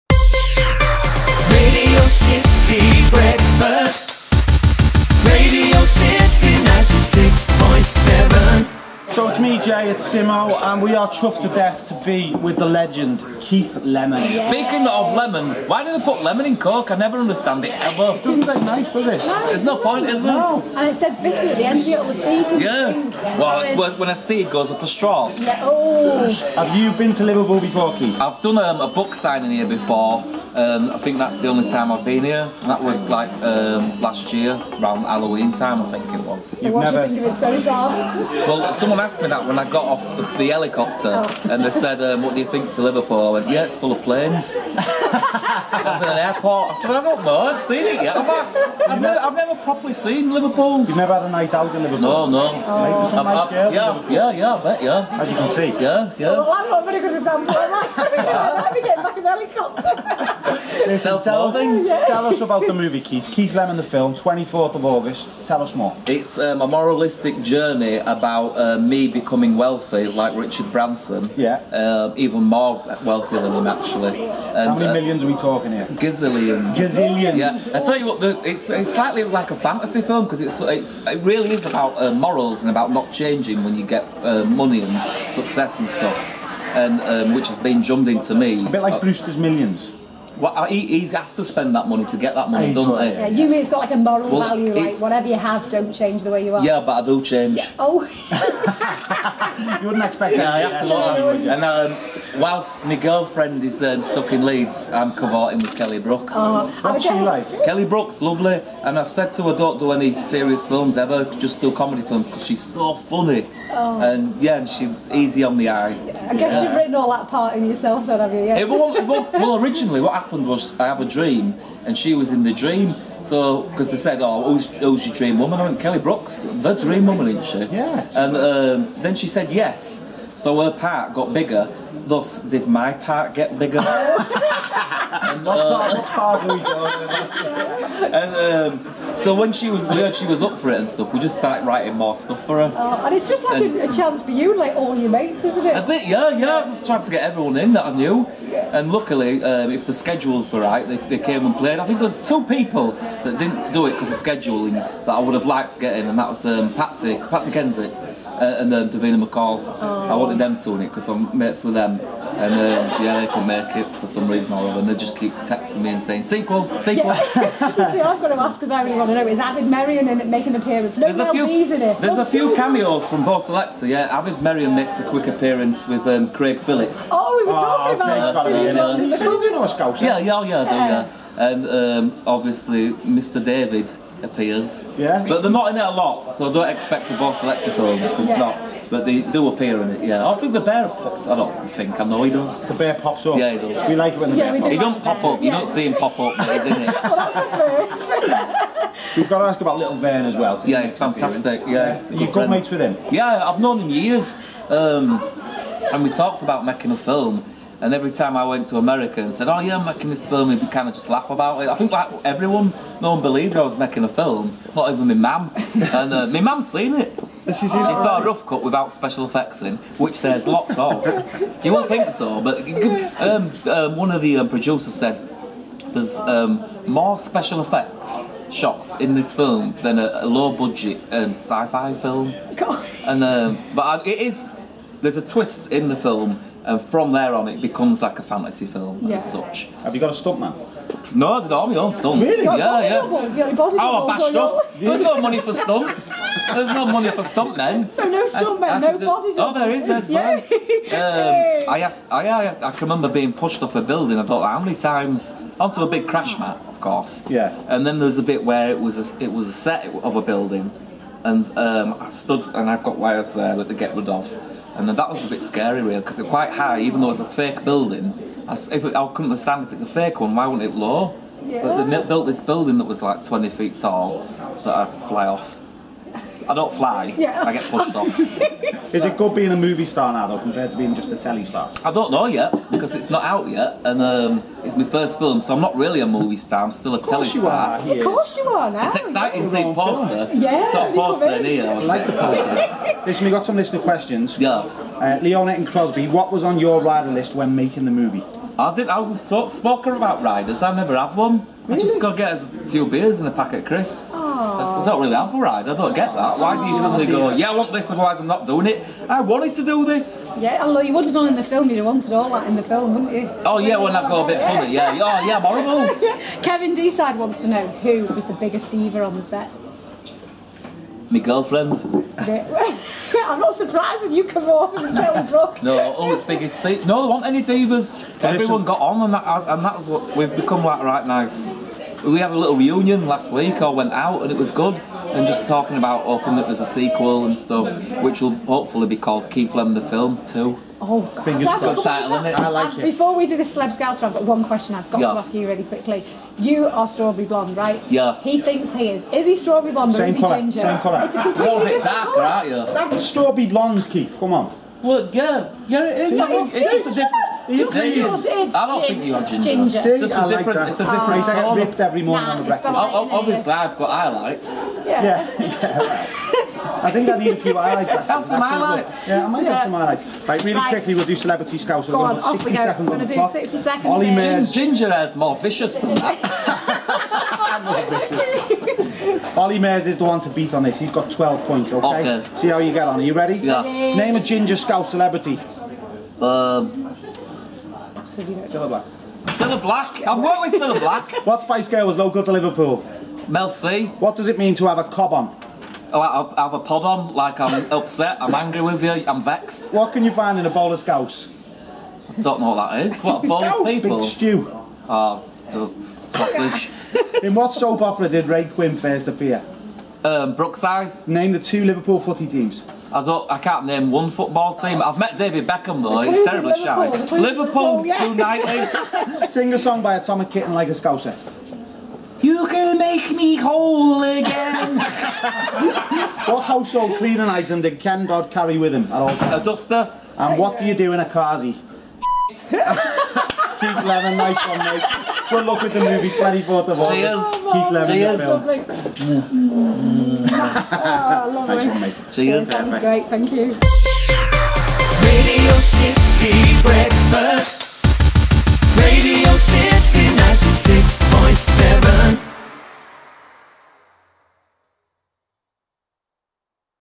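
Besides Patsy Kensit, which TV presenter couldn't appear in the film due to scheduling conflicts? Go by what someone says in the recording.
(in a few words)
Davina McCall.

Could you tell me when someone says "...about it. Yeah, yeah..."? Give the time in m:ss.
2:58.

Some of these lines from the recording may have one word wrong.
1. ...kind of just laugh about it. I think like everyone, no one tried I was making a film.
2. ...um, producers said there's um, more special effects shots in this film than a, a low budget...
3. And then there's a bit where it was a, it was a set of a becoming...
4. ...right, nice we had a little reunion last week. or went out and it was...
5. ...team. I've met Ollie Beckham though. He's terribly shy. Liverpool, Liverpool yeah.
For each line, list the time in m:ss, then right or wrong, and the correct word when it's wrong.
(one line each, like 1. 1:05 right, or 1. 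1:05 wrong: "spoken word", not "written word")
1. 3:30 wrong: "believed", not "tried"
2. 3:44 right
3. 4:17 wrong: "building", not "becoming"
4. 5:30 right
5. 6:54 wrong: "David", not "Ollie".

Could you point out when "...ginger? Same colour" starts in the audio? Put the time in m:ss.
5:50.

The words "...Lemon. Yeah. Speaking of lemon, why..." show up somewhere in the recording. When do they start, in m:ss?
0:13.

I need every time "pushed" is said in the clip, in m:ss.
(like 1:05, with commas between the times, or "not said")
4:13, 4:37.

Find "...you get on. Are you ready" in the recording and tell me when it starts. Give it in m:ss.
6:22.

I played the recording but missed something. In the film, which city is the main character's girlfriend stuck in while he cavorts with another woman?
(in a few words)
Leeds.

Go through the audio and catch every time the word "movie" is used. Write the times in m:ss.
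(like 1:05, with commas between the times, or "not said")
1:02, 4:39, 4:46, 4:57, 7:15.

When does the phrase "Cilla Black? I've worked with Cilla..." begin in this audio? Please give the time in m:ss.
6:29.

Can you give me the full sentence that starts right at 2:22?
Oh, and it's just like and, a, chance for you, like all your mates, isn't it?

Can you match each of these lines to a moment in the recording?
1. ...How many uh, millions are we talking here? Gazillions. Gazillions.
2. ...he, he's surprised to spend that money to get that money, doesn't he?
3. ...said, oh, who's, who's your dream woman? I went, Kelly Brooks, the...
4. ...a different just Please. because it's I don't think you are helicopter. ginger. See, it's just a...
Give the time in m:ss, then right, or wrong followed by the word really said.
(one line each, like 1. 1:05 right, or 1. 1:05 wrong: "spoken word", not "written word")
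1. 1:14 right
2. 1:30 wrong: "asked", not "surprised"
3. 2:03 right
4. 5:56 wrong: "ginger", not "helicopter".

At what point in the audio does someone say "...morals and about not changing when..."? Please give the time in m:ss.
1:22.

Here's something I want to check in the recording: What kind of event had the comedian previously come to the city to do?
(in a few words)
Book signing.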